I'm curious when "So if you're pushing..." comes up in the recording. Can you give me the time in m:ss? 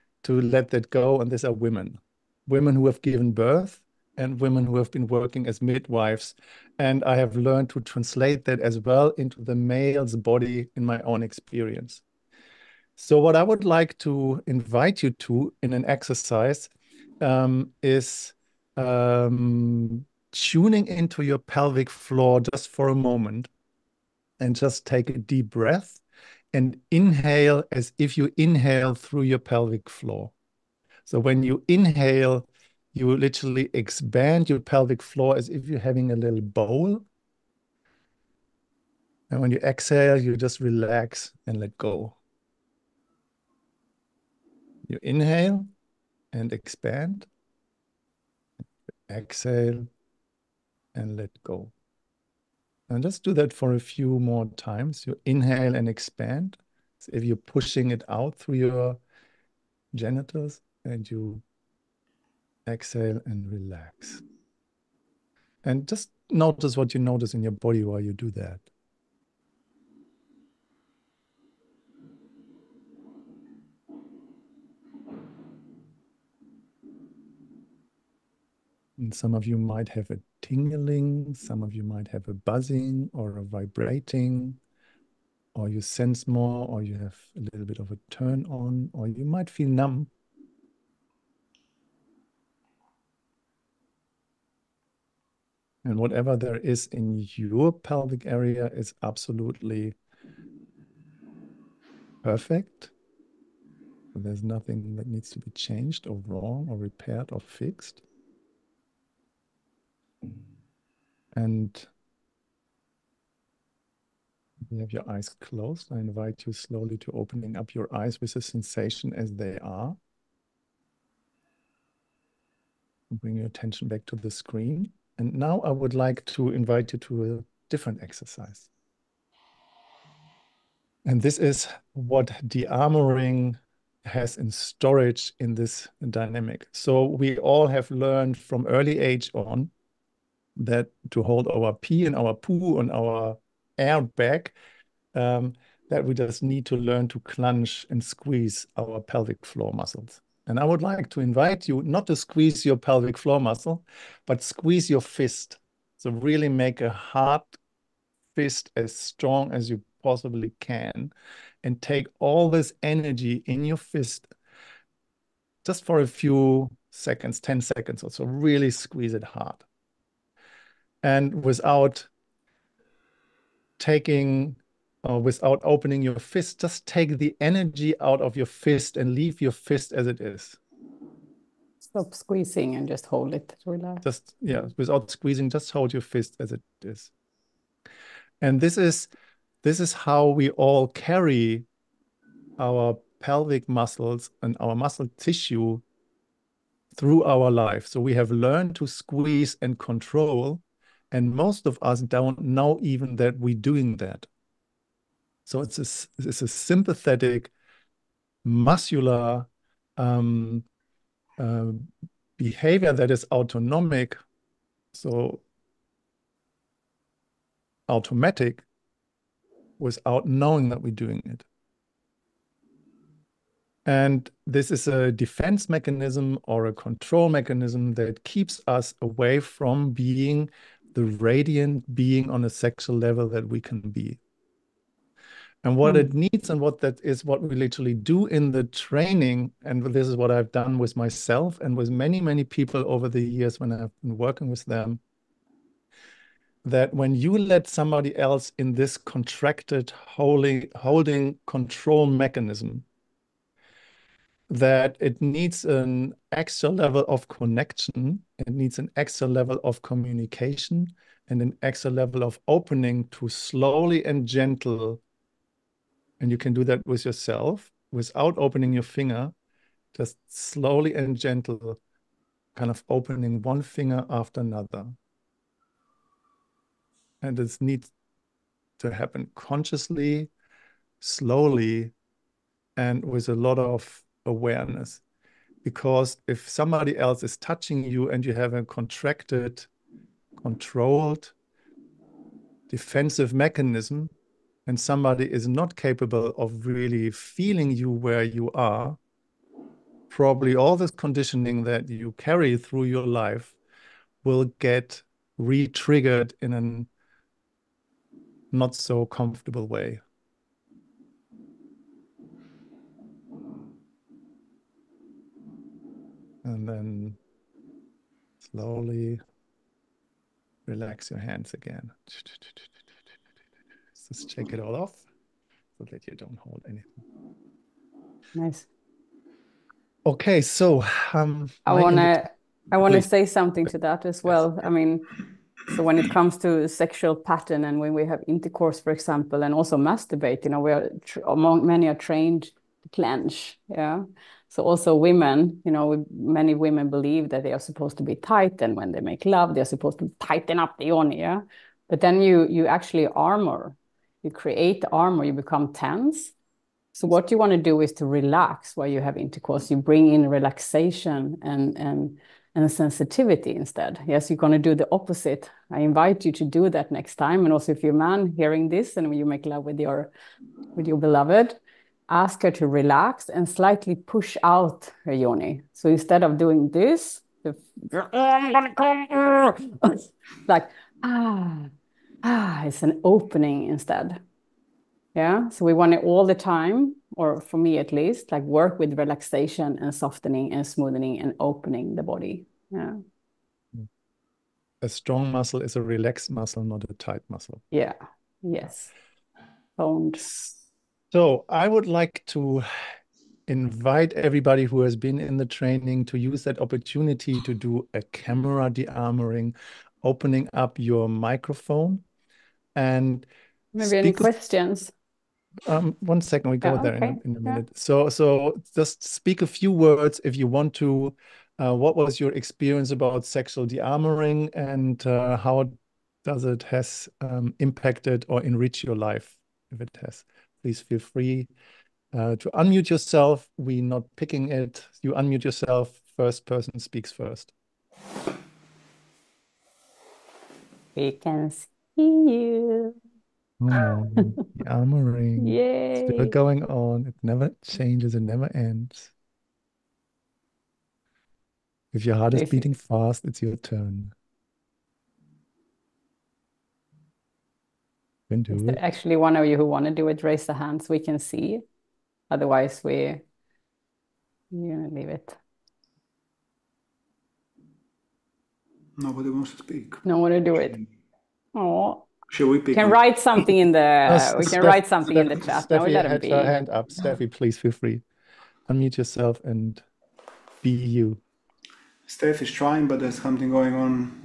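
0:56.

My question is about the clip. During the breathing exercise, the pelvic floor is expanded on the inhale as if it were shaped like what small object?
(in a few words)
a little bowl.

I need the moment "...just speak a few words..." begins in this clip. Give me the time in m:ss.
6:58.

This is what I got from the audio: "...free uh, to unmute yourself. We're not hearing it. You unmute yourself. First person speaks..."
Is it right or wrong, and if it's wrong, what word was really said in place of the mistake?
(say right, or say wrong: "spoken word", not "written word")
wrong: "picking", not "hearing".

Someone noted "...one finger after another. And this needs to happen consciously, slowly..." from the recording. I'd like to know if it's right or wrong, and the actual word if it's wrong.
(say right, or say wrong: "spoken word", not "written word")
right.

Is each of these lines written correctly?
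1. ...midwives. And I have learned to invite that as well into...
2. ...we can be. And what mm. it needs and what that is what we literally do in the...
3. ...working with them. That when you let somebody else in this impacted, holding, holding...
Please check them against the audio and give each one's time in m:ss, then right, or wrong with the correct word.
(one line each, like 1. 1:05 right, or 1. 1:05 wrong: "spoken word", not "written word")
1. 0:05 wrong: "translate", not "invite"
2. 3:53 right
3. 4:04 wrong: "contracted", not "impacted".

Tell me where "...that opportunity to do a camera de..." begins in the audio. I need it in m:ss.
6:46.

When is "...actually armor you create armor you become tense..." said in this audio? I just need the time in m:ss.
5:52.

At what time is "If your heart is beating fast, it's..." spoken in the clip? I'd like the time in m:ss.
7:31.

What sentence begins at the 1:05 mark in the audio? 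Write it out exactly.
And just notice what you notice in your body while you do that.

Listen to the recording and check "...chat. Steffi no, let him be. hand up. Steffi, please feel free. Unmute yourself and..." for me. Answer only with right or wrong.
right.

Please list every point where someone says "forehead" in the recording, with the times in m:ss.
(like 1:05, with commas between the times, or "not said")
not said.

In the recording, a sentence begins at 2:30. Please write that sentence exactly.
And I would like to invite you not to squeeze your pelvic floor muscle, but squeeze your fist.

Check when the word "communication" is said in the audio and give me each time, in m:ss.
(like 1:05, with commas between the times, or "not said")
4:19.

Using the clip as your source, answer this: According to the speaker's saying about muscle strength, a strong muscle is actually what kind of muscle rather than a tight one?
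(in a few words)
a relaxed muscle.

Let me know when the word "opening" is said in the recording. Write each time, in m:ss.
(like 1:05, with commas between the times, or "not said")
1:57, 2:55, 4:22, 4:28, 4:32, 6:23, 6:31, 6:50.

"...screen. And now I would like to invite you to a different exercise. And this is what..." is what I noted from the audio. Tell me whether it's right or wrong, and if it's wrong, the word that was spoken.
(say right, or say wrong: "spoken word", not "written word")
right.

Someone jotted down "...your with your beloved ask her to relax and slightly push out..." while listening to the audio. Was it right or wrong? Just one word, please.
right.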